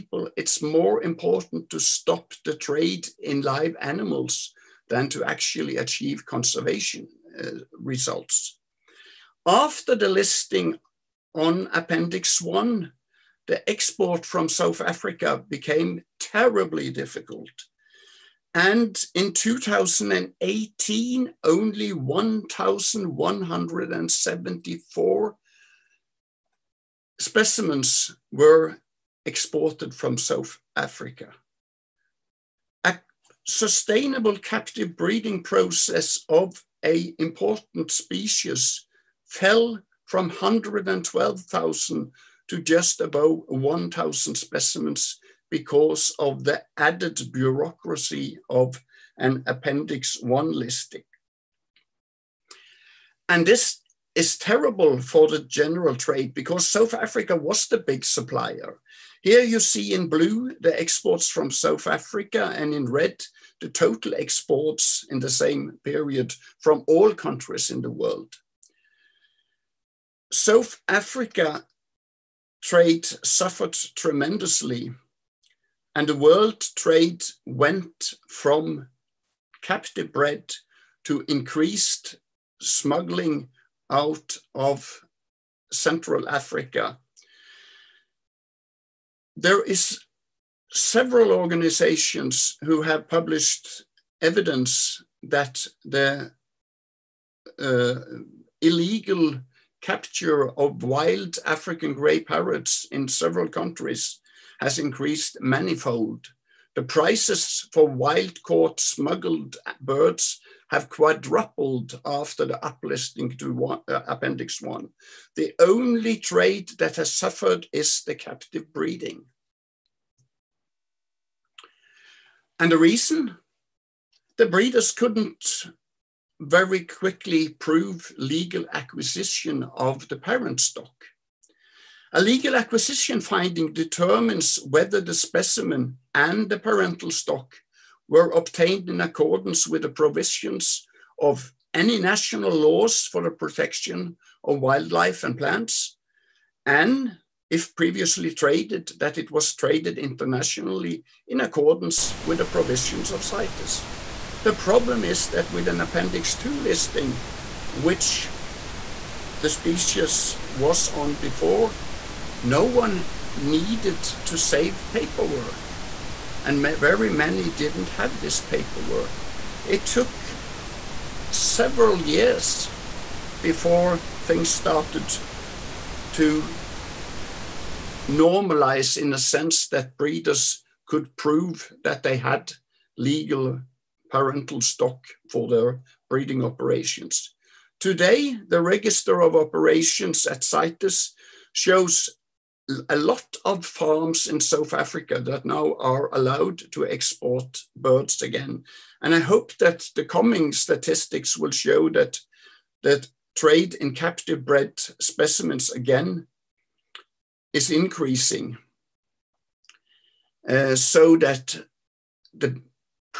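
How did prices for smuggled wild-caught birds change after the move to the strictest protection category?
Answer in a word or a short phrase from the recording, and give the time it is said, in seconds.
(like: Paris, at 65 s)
Quadrupled, at 110 s.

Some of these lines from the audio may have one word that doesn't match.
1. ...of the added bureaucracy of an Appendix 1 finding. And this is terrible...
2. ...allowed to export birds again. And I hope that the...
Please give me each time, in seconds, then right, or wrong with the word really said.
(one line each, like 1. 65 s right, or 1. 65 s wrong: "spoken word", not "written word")
1. 46 s wrong: "listing", not "finding"
2. 196 s right.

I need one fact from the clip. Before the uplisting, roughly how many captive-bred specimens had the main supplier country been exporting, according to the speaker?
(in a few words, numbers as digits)
112,000.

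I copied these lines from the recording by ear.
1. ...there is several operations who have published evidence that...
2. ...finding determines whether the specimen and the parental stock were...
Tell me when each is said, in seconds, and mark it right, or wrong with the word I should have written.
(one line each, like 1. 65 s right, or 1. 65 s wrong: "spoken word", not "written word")
1. 89 s wrong: "organizations", not "operations"
2. 133 s right.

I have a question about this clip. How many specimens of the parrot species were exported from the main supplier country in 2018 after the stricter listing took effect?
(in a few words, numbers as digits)
1,174.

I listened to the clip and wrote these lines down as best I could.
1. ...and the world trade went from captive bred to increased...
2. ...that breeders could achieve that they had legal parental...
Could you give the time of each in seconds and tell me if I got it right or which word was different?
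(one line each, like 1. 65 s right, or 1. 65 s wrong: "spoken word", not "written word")
1. 75 s right
2. 179 s wrong: "prove", not "achieve".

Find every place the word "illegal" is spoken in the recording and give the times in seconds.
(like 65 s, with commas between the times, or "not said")
98 s.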